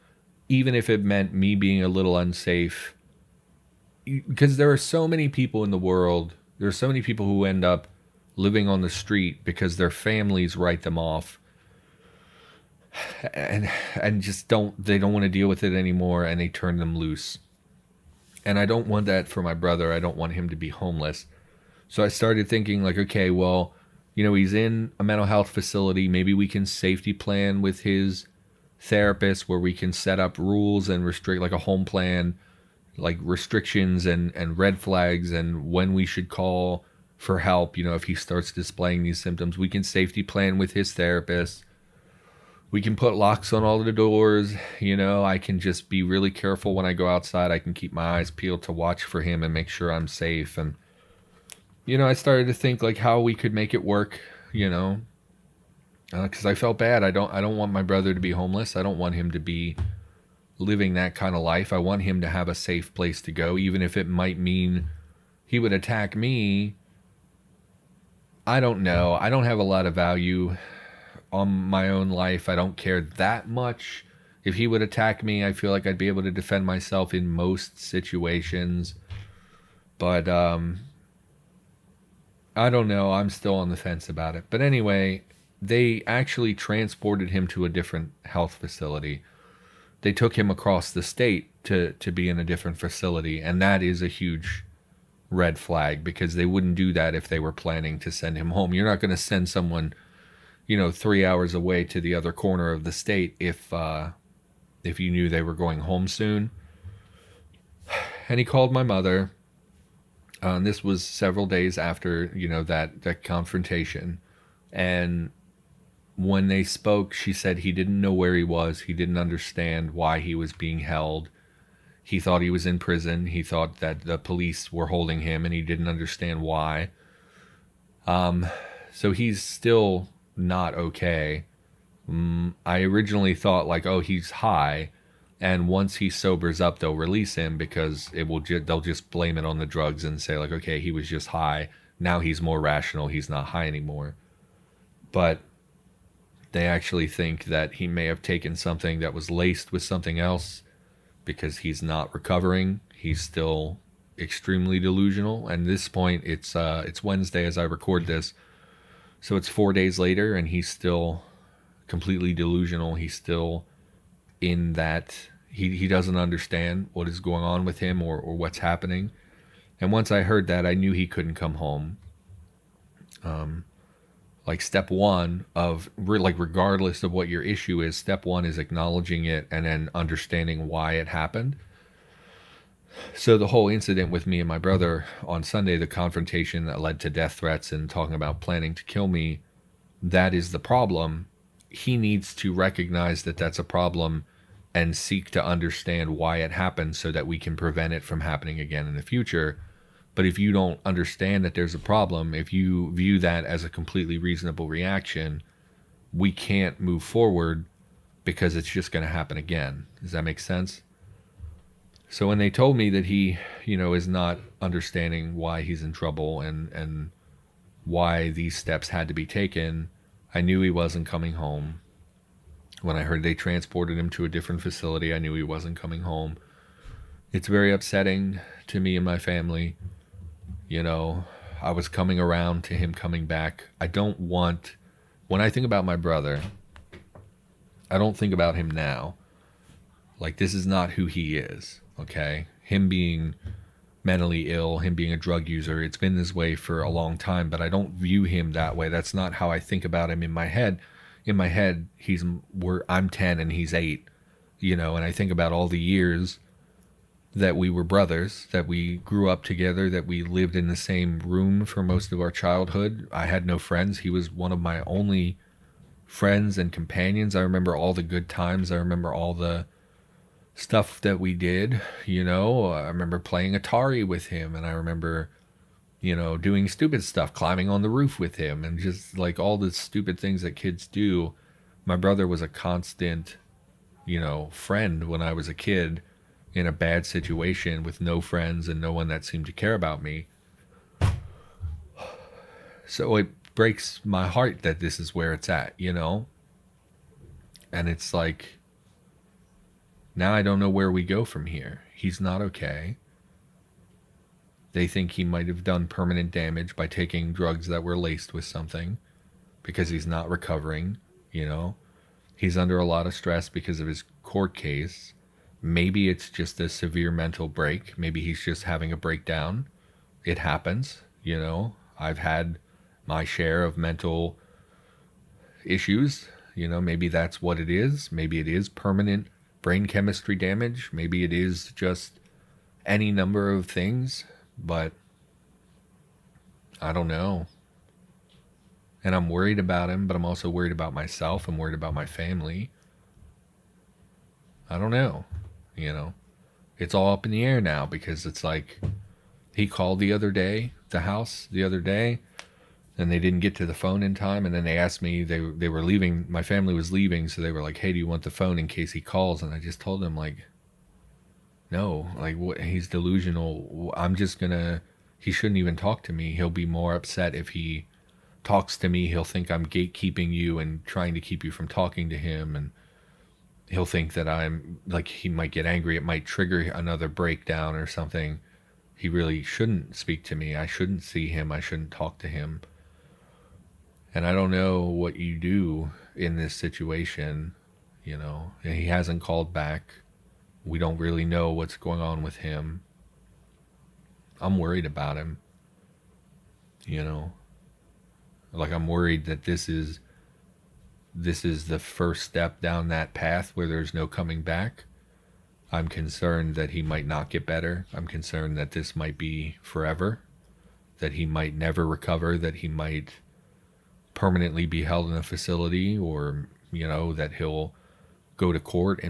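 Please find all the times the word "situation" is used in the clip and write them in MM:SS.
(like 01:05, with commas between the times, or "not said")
01:17, 04:47, 06:26.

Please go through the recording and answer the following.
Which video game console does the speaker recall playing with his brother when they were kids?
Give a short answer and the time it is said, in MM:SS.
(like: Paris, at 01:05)
Atari, at 04:33.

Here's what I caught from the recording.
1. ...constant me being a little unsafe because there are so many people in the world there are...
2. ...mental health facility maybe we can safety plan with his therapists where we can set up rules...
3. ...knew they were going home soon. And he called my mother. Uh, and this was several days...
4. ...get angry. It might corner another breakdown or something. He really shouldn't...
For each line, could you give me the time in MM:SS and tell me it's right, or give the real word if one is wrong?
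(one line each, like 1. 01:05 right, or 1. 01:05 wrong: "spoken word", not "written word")
1. 00:01 wrong: "meant", not "constant"
2. 00:25 right
3. 01:45 right
4. 06:15 wrong: "trigger", not "corner".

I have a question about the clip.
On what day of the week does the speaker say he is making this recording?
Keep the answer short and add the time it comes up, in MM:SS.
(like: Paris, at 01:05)
Wednesday, at 02:37.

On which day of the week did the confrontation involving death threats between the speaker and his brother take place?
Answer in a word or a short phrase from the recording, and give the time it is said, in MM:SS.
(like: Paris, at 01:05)
Sunday, at 03:05.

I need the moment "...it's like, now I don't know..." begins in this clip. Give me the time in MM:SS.
04:57.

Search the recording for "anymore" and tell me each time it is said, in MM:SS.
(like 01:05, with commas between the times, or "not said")
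00:15, 02:23.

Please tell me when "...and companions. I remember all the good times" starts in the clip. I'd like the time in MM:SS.
04:26.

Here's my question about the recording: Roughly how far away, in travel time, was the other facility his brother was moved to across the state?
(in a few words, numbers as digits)
3 hours.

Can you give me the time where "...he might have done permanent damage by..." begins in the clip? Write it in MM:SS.
05:05.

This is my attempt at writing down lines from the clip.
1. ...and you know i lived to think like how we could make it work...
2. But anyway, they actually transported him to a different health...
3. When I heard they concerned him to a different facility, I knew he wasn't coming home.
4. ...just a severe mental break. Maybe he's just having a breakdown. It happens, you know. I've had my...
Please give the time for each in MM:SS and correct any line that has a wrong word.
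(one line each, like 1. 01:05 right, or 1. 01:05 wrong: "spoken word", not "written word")
1. 00:50 wrong: "started", not "lived"
2. 01:24 right
3. 03:42 wrong: "transported", not "concerned"
4. 05:16 right.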